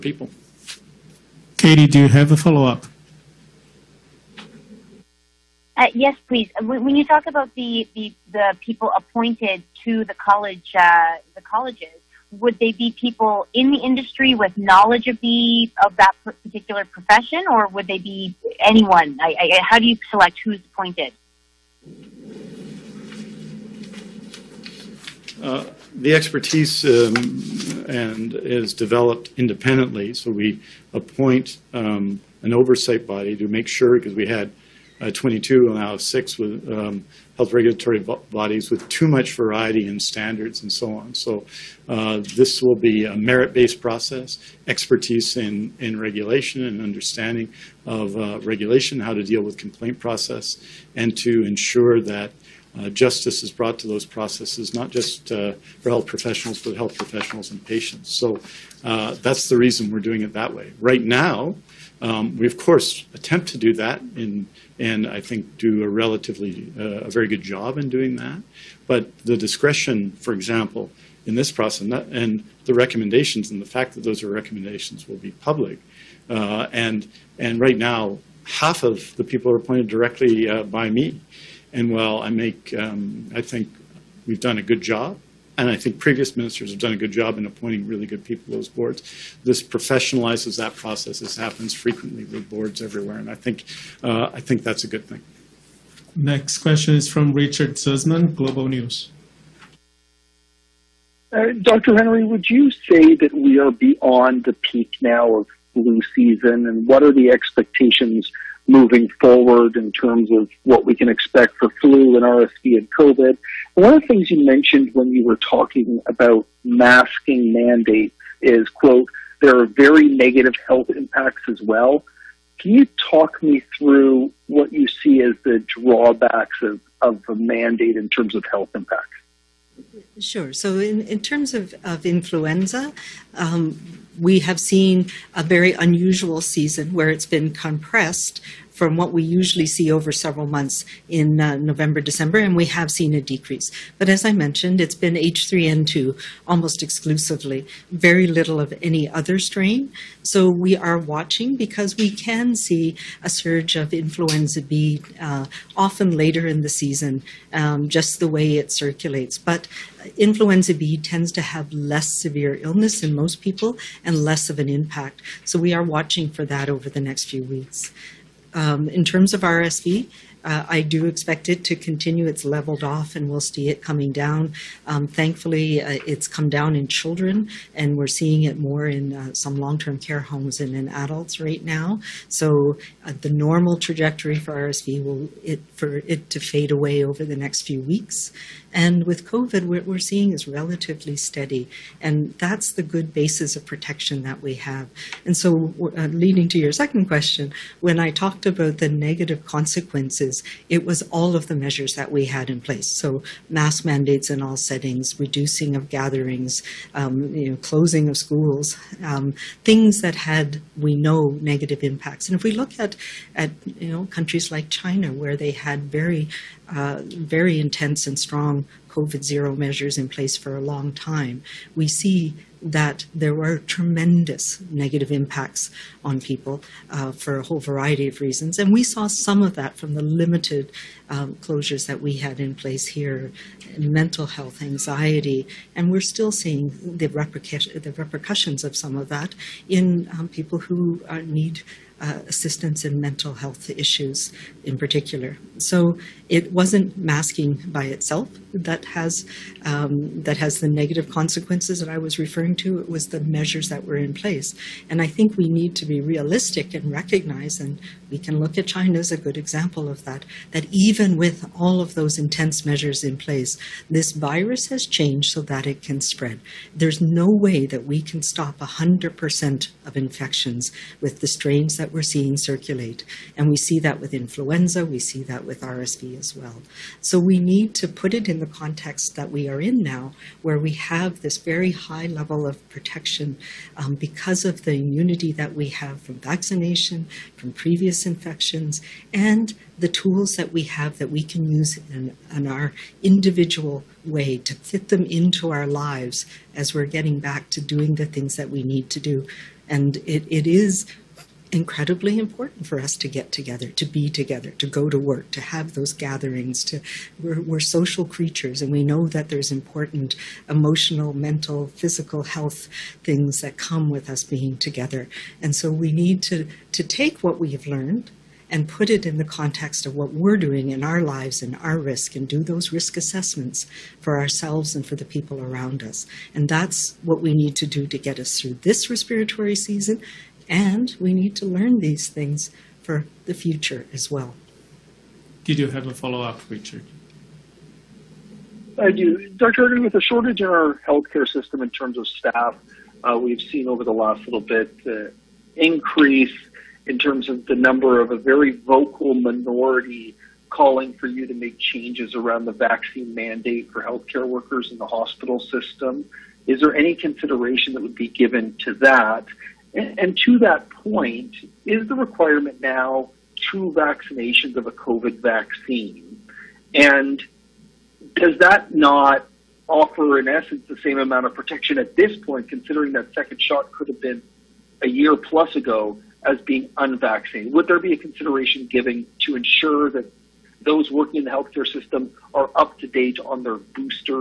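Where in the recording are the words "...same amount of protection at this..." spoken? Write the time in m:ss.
6:10.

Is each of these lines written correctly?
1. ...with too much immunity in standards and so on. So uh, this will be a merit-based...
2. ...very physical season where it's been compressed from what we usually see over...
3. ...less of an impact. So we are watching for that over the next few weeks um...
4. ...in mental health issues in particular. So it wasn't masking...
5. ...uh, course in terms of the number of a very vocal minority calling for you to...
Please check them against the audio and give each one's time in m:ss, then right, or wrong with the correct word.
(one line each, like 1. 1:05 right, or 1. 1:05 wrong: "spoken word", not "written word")
1. 0:38 wrong: "variety", not "immunity"
2. 2:15 wrong: "unusual", not "physical"
3. 2:44 right
4. 4:02 right
5. 5:44 wrong: "increase", not "course".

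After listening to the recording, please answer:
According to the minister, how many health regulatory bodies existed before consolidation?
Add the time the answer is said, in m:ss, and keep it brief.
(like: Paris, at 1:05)
22, at 0:35.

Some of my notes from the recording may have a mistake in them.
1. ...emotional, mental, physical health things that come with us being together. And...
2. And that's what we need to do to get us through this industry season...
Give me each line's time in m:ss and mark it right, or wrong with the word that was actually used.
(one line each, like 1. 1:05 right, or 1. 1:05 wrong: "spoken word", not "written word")
1. 5:10 right
2. 5:26 wrong: "respiratory", not "industry".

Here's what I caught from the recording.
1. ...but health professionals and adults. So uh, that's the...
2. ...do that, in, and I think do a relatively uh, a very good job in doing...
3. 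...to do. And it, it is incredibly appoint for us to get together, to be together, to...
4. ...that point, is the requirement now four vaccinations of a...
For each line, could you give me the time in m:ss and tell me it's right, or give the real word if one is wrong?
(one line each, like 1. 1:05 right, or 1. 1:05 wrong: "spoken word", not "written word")
1. 0:56 wrong: "patients", not "adults"
2. 1:03 right
3. 4:58 wrong: "important", not "appoint"
4. 6:00 wrong: "two", not "four".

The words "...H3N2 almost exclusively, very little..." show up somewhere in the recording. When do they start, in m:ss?
2:25.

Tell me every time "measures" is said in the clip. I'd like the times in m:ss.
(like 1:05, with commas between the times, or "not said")
3:21, 3:39, 4:13, 4:22.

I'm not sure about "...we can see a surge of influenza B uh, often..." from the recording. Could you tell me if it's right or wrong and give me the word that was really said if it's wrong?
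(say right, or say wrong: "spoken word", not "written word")
right.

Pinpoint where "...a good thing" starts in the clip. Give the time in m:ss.
1:34.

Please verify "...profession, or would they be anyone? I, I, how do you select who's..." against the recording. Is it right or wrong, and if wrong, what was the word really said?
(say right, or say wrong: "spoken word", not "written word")
right.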